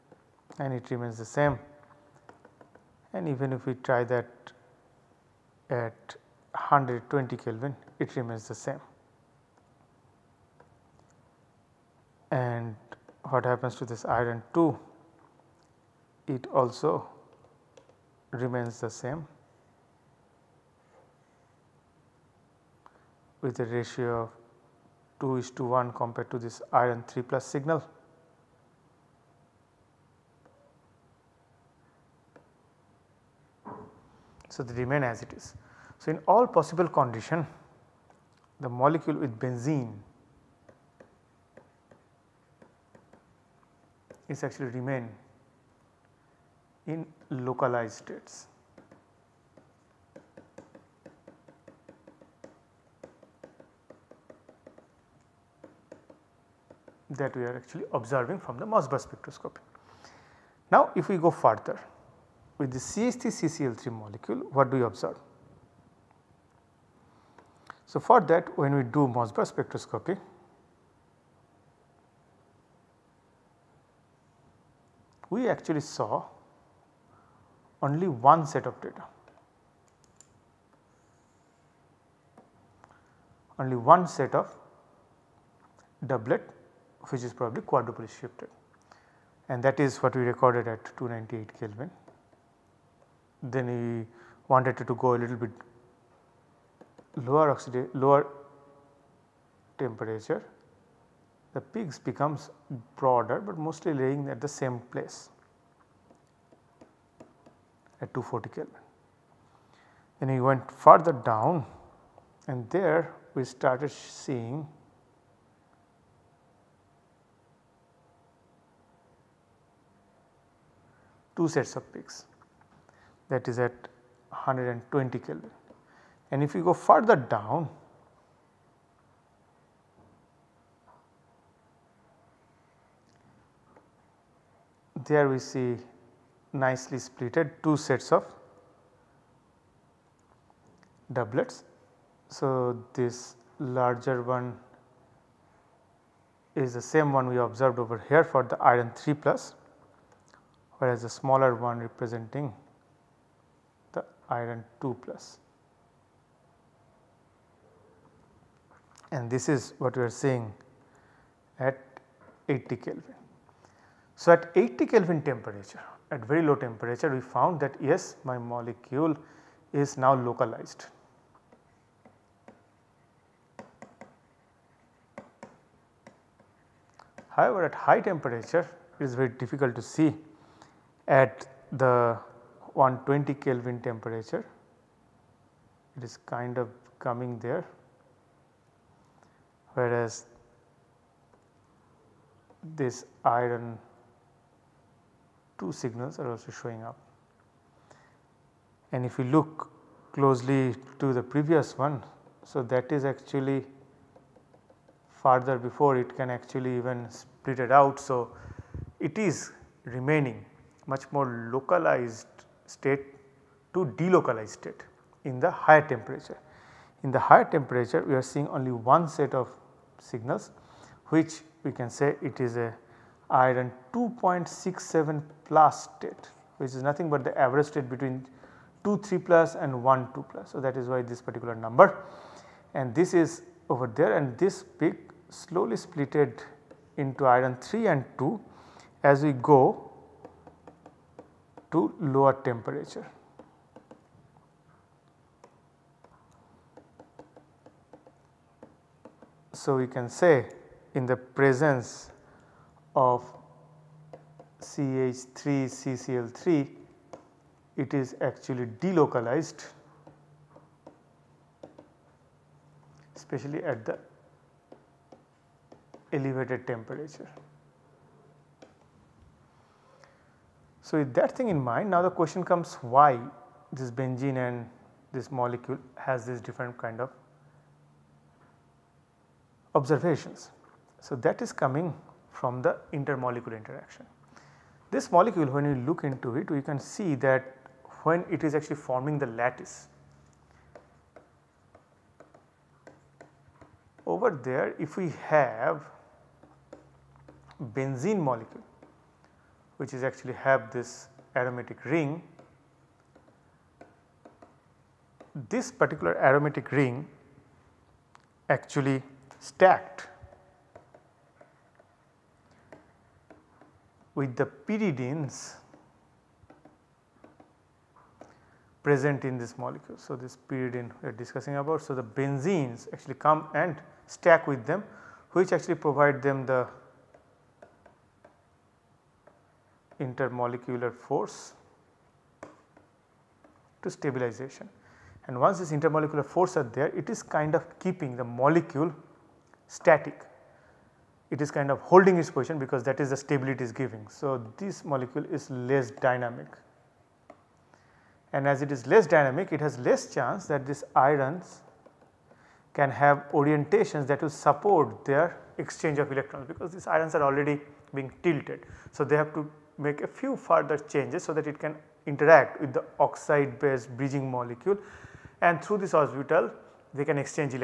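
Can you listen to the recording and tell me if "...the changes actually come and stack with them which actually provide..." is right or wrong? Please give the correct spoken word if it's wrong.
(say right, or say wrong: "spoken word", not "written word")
wrong: "benzenes", not "changes".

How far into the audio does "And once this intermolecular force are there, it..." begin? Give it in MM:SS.
05:35.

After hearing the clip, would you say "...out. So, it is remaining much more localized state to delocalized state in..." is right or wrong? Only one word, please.
right.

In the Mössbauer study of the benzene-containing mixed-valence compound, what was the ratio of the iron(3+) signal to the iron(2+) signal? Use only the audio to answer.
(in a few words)
2 to 1.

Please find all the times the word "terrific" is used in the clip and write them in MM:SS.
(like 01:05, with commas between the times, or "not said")
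not said.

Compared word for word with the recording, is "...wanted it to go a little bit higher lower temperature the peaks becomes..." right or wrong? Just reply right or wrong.
wrong.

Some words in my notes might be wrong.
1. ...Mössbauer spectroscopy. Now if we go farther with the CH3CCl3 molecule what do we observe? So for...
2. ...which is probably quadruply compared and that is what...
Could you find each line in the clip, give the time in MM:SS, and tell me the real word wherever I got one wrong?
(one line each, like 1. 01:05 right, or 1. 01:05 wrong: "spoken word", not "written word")
1. 00:58 wrong: "further", not "farther"
2. 01:27 wrong: "shifted", not "compared".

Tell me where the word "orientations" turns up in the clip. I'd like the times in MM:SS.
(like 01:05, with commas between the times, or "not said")
05:53.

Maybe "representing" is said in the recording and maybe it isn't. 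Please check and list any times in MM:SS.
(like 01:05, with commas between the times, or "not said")
02:31.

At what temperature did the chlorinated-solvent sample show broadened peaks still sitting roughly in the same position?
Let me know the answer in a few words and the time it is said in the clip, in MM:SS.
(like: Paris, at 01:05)
240 Kelvin, at 01:48.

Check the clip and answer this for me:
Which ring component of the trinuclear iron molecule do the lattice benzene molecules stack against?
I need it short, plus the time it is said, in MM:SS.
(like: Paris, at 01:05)
pyridines, at 05:14.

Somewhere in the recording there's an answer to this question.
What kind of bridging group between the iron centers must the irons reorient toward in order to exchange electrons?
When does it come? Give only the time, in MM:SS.
06:02.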